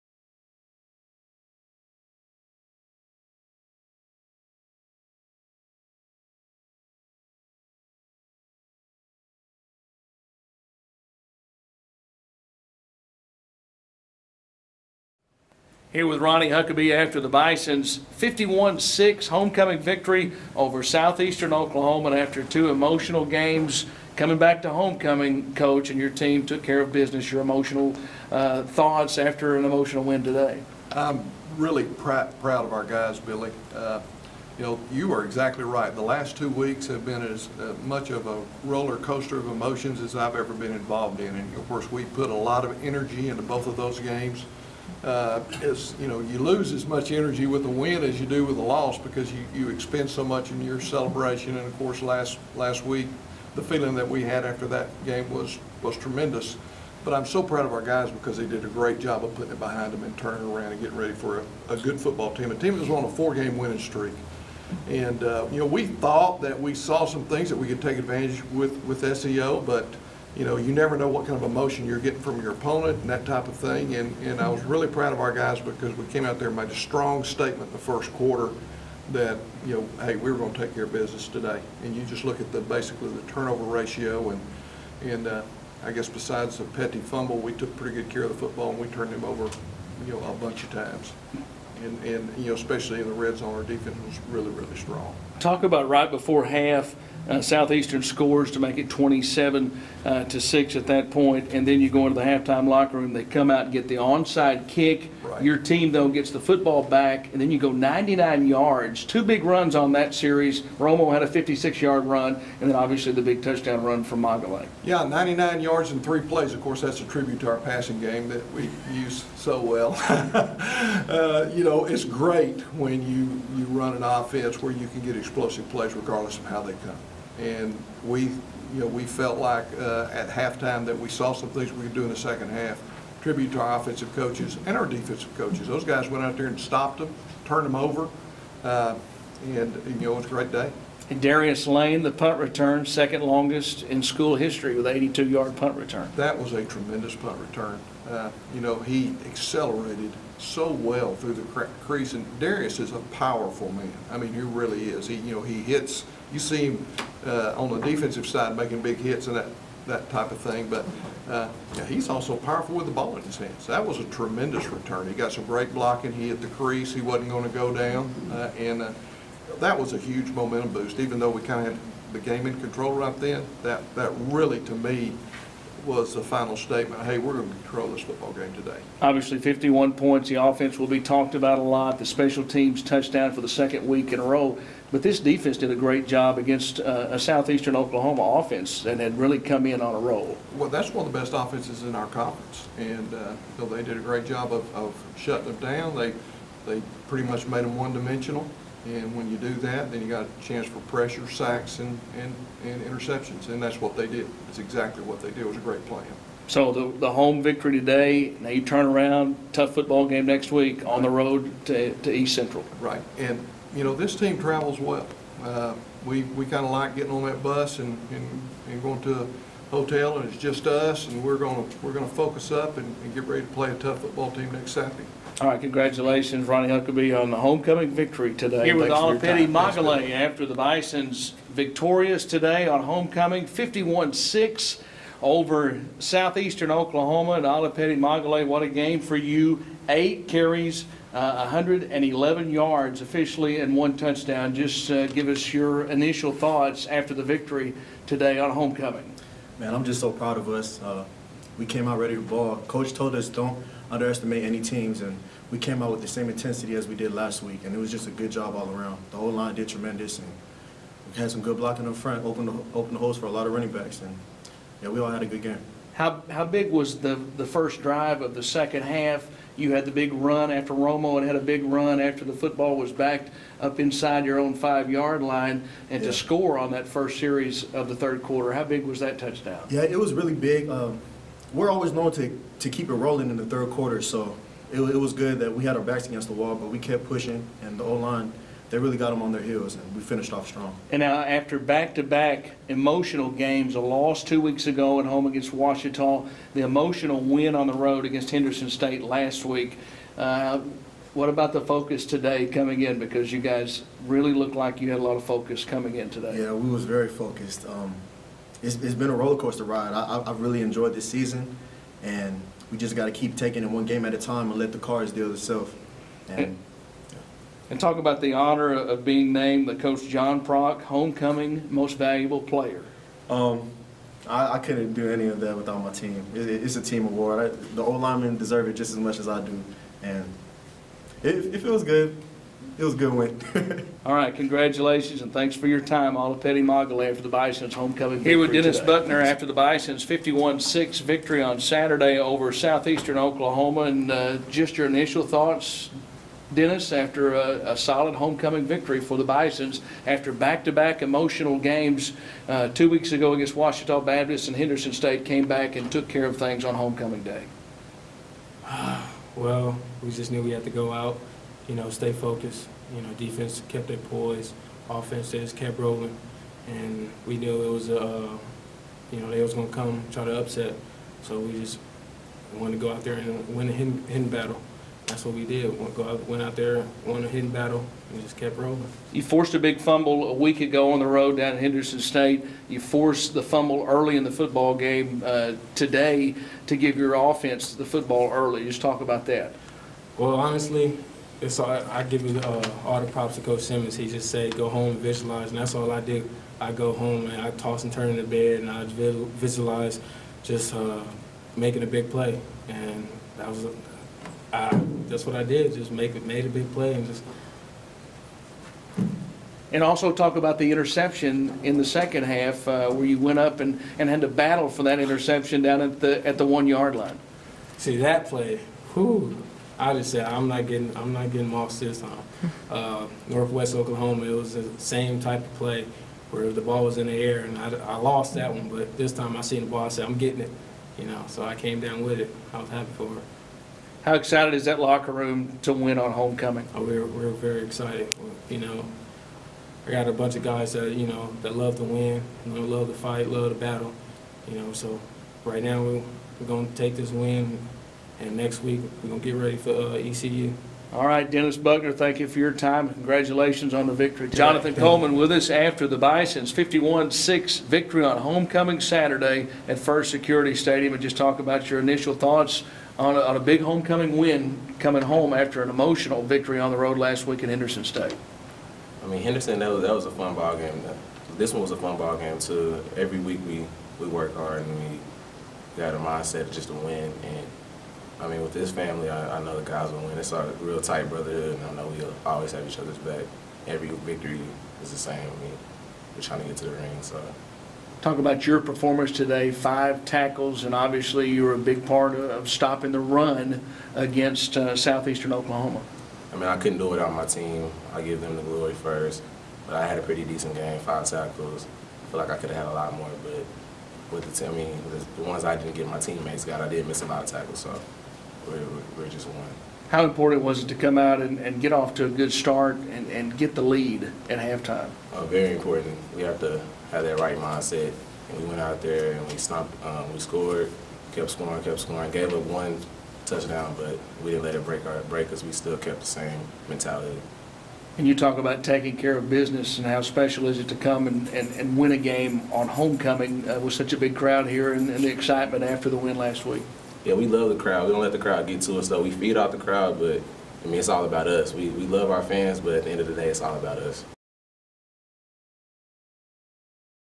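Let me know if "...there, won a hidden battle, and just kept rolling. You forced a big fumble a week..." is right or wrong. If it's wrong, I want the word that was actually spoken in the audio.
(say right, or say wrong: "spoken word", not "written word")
right.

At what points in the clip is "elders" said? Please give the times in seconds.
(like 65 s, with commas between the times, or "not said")
not said.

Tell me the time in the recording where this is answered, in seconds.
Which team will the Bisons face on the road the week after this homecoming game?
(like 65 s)
212 s.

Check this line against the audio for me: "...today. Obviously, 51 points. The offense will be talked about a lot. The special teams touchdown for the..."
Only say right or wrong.
right.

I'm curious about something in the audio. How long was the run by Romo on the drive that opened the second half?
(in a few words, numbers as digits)
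56 yards.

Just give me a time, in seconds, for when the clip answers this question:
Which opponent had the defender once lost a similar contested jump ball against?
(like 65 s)
423 s.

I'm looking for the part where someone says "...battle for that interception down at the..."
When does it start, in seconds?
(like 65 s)
414 s.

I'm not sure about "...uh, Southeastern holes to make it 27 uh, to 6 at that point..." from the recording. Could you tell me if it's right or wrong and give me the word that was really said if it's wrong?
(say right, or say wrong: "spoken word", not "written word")
wrong: "scores", not "holes".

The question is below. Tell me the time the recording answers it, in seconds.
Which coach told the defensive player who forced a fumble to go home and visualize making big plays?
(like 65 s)
393 s.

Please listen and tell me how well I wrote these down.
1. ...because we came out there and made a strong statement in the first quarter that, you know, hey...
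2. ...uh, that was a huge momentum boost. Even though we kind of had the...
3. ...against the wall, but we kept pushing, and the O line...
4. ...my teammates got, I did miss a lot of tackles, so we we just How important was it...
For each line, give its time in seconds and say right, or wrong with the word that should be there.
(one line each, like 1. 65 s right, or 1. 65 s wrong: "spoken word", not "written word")
1. 75 s right
2. 168 s right
3. 286 s right
4. 505 s right.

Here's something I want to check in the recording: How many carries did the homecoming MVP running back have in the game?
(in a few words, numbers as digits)
8.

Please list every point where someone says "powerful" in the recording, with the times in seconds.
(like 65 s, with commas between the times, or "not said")
153 s, 162 s.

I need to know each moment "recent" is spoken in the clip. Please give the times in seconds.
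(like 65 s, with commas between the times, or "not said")
not said.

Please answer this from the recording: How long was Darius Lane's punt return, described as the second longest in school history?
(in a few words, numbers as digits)
82 yards.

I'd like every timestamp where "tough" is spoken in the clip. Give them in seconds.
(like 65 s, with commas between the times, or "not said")
209 s, 223 s.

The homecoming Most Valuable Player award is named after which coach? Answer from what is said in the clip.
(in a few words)
John Prock.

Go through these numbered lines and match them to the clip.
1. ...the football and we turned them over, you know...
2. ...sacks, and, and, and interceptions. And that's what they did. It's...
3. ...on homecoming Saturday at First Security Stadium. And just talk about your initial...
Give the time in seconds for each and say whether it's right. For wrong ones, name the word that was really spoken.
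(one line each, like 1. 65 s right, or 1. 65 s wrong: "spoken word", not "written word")
1. 88 s right
2. 201 s right
3. 458 s right.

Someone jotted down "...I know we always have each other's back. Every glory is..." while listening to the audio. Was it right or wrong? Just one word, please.
wrong.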